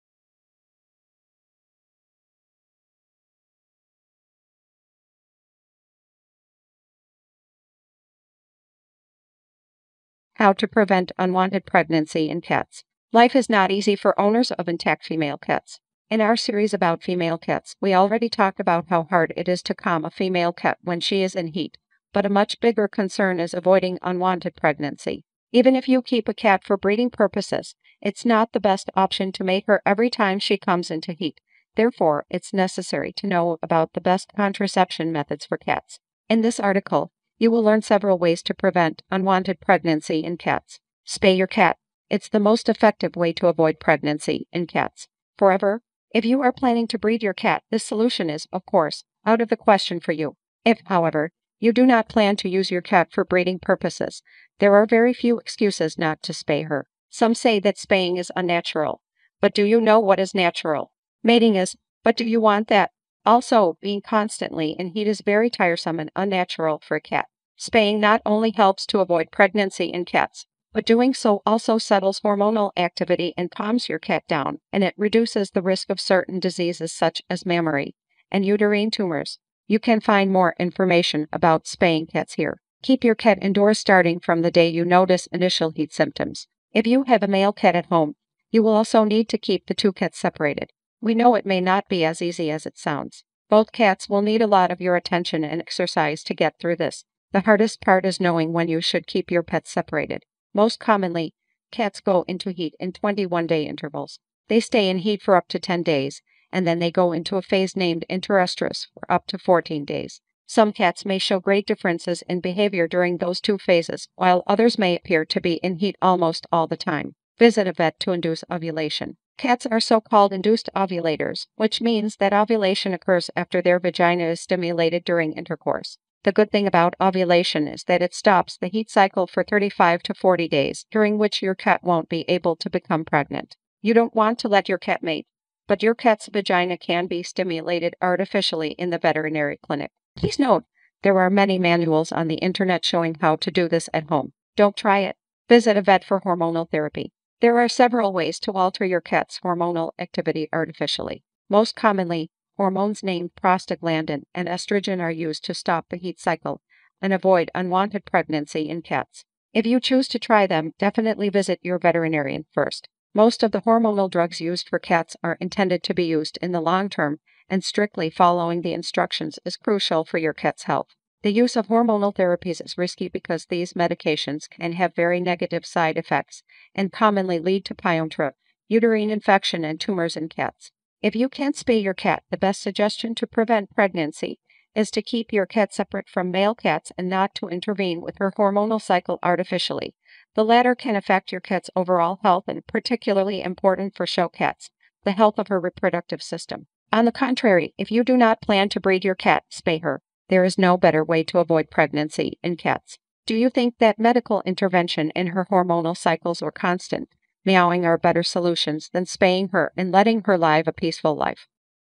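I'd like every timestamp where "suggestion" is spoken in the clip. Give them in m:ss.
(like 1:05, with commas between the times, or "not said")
3:02.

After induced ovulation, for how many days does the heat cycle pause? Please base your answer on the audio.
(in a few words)
35 to 40 days.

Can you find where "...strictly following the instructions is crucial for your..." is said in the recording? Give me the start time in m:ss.
2:47.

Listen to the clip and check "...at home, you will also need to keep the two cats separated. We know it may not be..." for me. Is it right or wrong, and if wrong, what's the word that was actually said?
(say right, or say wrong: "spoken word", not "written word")
right.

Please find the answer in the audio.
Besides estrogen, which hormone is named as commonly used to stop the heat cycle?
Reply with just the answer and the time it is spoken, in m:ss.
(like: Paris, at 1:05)
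prostaglandin, at 2:33.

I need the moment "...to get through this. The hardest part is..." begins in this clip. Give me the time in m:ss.
1:36.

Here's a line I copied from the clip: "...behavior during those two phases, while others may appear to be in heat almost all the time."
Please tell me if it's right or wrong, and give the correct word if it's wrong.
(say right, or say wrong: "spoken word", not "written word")
right.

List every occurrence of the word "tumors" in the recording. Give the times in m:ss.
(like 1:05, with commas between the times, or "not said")
1:18, 2:59.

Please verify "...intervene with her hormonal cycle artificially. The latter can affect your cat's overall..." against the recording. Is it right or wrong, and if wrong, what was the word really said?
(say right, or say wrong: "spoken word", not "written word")
right.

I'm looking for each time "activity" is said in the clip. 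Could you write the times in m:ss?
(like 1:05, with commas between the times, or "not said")
1:12, 2:29.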